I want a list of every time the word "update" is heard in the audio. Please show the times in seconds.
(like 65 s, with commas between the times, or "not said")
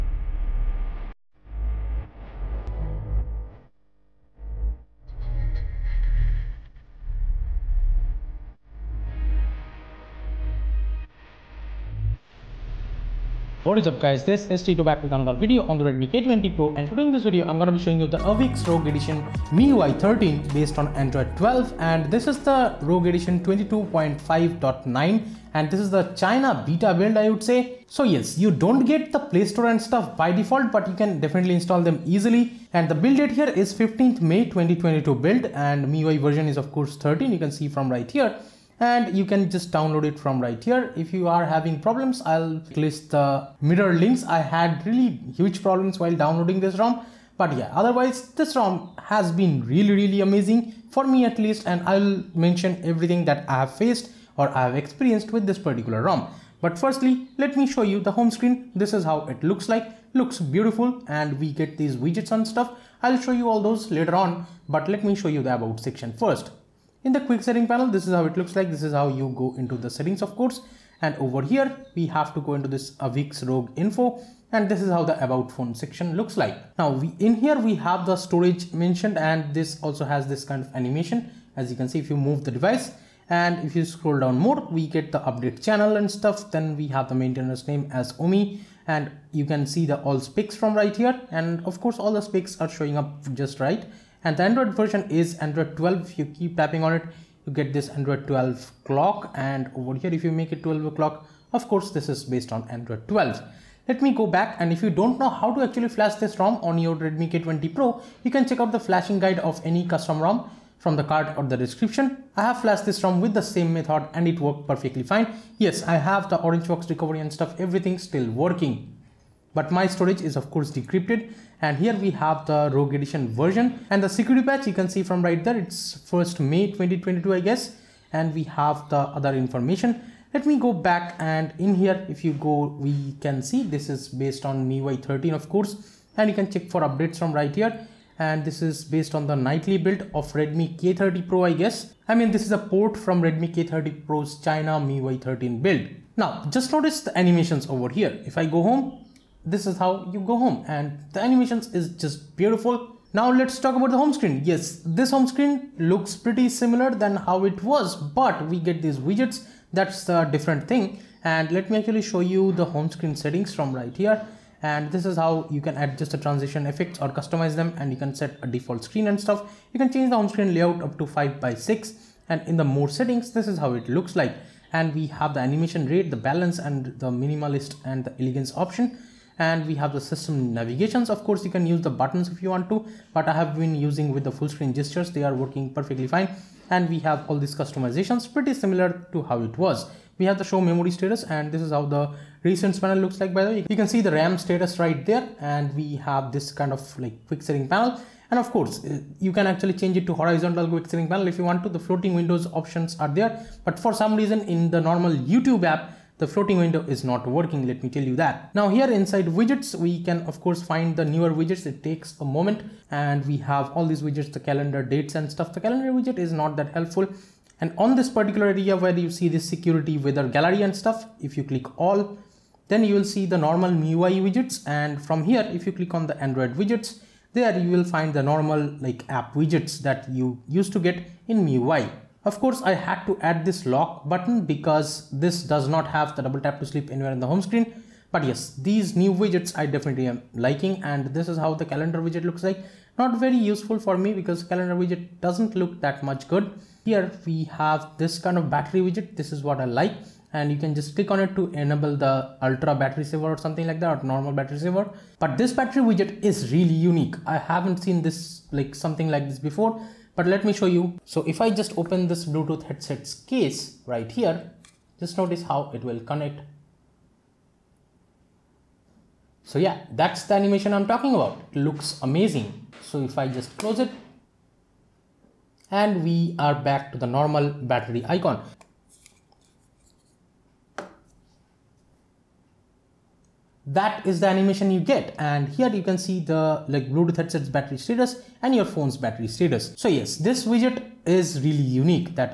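85 s, 136 s.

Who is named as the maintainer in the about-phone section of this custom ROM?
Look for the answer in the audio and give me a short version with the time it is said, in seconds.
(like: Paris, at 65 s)
Omi, at 88 s.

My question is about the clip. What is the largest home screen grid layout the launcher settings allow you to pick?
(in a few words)
5 by 6.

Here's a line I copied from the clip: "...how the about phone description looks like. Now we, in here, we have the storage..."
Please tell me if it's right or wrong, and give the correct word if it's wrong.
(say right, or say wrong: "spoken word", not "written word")
wrong: "section", not "description".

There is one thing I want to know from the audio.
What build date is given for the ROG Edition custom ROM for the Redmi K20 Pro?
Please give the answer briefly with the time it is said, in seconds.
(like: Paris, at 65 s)
15 May 2022, at 33 s.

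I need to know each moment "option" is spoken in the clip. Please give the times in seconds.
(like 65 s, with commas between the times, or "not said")
178 s, 202 s.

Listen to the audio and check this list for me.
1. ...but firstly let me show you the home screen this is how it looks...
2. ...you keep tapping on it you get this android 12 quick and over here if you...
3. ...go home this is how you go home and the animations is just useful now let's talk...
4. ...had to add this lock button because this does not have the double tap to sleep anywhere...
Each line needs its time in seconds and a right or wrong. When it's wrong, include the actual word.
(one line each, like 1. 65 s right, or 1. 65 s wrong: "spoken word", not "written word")
1. 56 s right
2. 96 s wrong: "clock", not "quick"
3. 148 s wrong: "beautiful", not "useful"
4. 232 s right.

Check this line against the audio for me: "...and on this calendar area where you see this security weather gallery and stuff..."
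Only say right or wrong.
wrong.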